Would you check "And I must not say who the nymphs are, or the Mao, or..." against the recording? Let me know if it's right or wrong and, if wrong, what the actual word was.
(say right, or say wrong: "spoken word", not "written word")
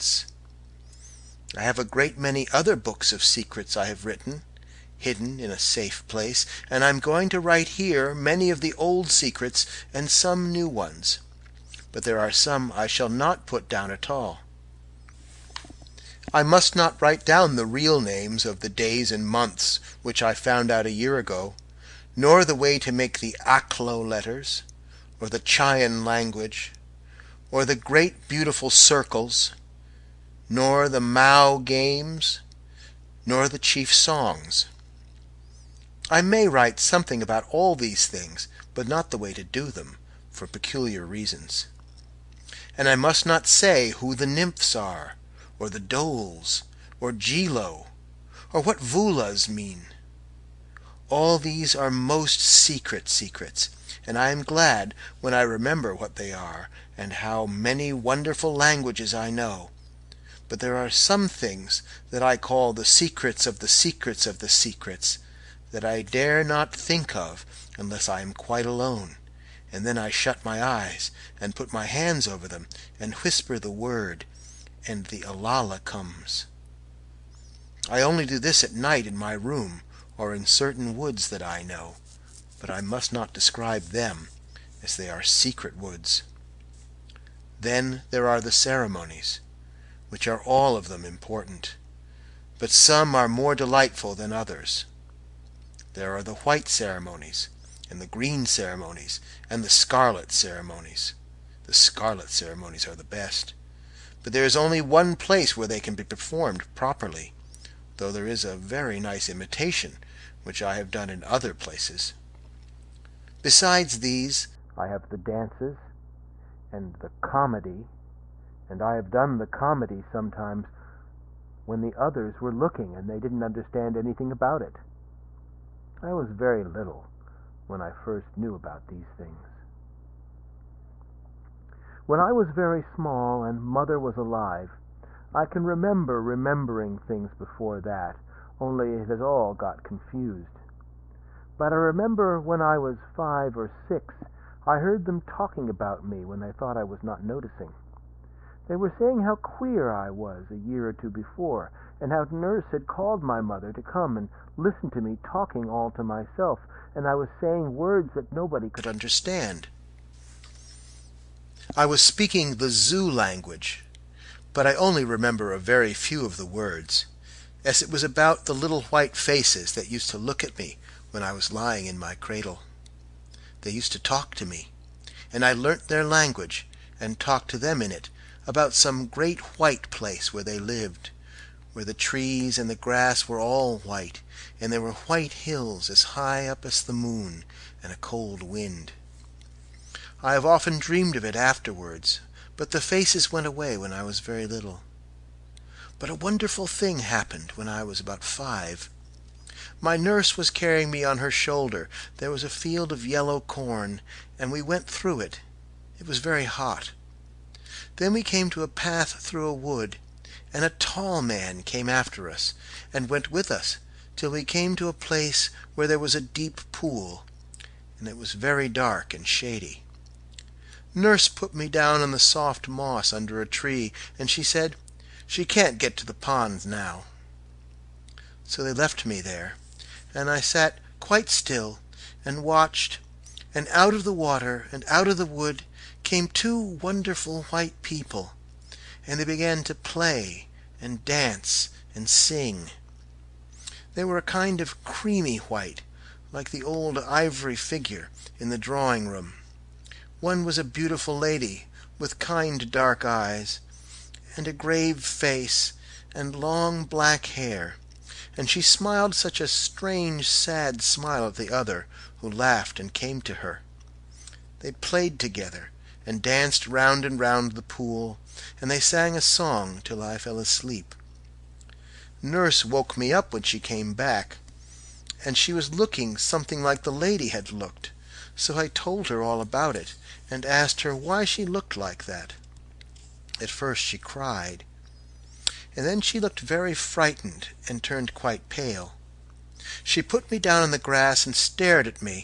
wrong: "Dôls", not "Mao".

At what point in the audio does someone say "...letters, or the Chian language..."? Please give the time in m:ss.
0:24.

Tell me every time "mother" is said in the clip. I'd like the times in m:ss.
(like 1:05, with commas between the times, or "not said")
2:13, 2:33.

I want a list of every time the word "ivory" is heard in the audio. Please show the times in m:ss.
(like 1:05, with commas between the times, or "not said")
4:06.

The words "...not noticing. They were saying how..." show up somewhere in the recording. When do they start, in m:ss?
2:27.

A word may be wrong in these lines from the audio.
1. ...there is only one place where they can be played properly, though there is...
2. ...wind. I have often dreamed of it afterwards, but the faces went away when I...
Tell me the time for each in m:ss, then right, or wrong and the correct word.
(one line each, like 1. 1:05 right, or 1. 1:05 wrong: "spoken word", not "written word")
1. 1:44 wrong: "performed", not "played"
2. 3:08 right.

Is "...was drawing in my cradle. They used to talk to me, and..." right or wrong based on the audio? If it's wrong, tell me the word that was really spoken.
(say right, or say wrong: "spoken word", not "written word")
wrong: "lying", not "drawing".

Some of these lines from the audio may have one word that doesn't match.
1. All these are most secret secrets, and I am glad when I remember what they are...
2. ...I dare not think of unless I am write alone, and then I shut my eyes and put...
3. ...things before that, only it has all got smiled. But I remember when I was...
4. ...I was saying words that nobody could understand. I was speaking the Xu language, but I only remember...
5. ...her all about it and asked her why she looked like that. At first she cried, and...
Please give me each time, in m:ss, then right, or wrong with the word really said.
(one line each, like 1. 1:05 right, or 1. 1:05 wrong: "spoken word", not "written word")
1. 0:51 right
2. 1:05 wrong: "quite", not "write"
3. 2:16 wrong: "confused", not "smiled"
4. 2:37 right
5. 4:39 right.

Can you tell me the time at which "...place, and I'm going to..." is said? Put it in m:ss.
0:06.